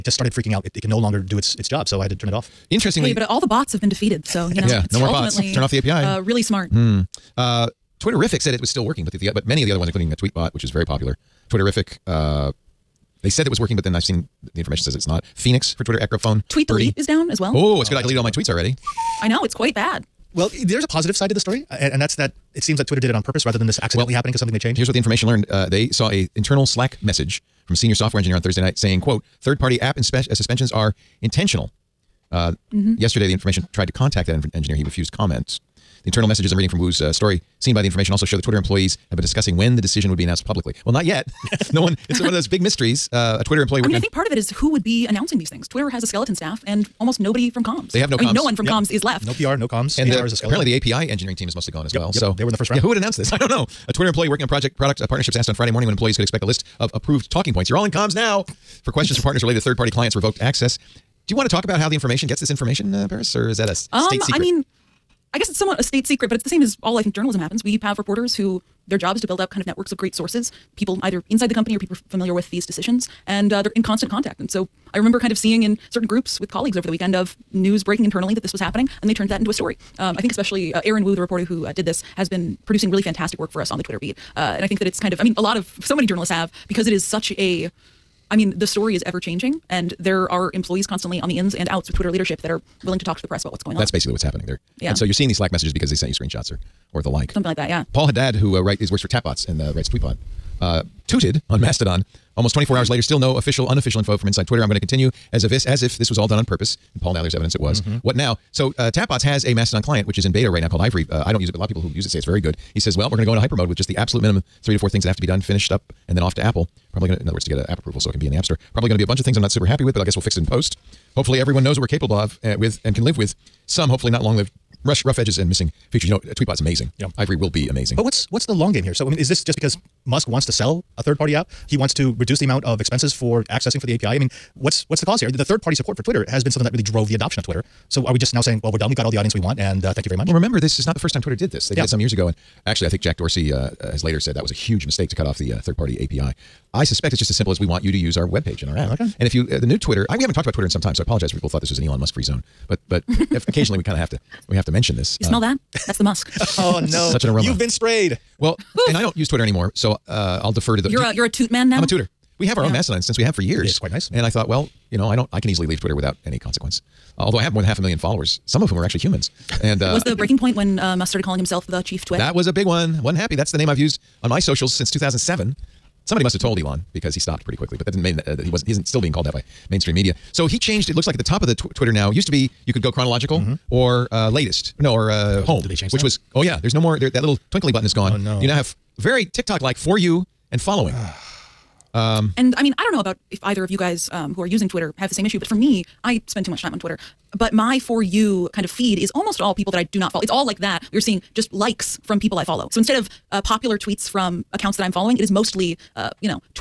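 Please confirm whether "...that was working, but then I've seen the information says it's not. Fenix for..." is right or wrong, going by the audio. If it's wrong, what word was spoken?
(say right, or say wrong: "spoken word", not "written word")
right.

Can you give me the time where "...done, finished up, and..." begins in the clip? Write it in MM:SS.
01:55.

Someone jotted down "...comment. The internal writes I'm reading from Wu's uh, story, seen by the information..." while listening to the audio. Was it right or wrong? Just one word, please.
wrong.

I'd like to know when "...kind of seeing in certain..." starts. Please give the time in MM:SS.
01:15.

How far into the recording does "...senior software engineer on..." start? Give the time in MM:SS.
00:27.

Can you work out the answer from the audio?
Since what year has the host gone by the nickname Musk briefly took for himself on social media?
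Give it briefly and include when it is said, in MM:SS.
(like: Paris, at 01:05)
2007, at 02:54.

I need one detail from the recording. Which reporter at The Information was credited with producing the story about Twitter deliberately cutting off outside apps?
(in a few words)
Aaron Wu.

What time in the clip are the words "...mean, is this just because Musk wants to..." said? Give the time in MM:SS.
02:09.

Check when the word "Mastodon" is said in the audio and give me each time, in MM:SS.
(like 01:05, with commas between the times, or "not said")
01:41, 01:49, 02:42.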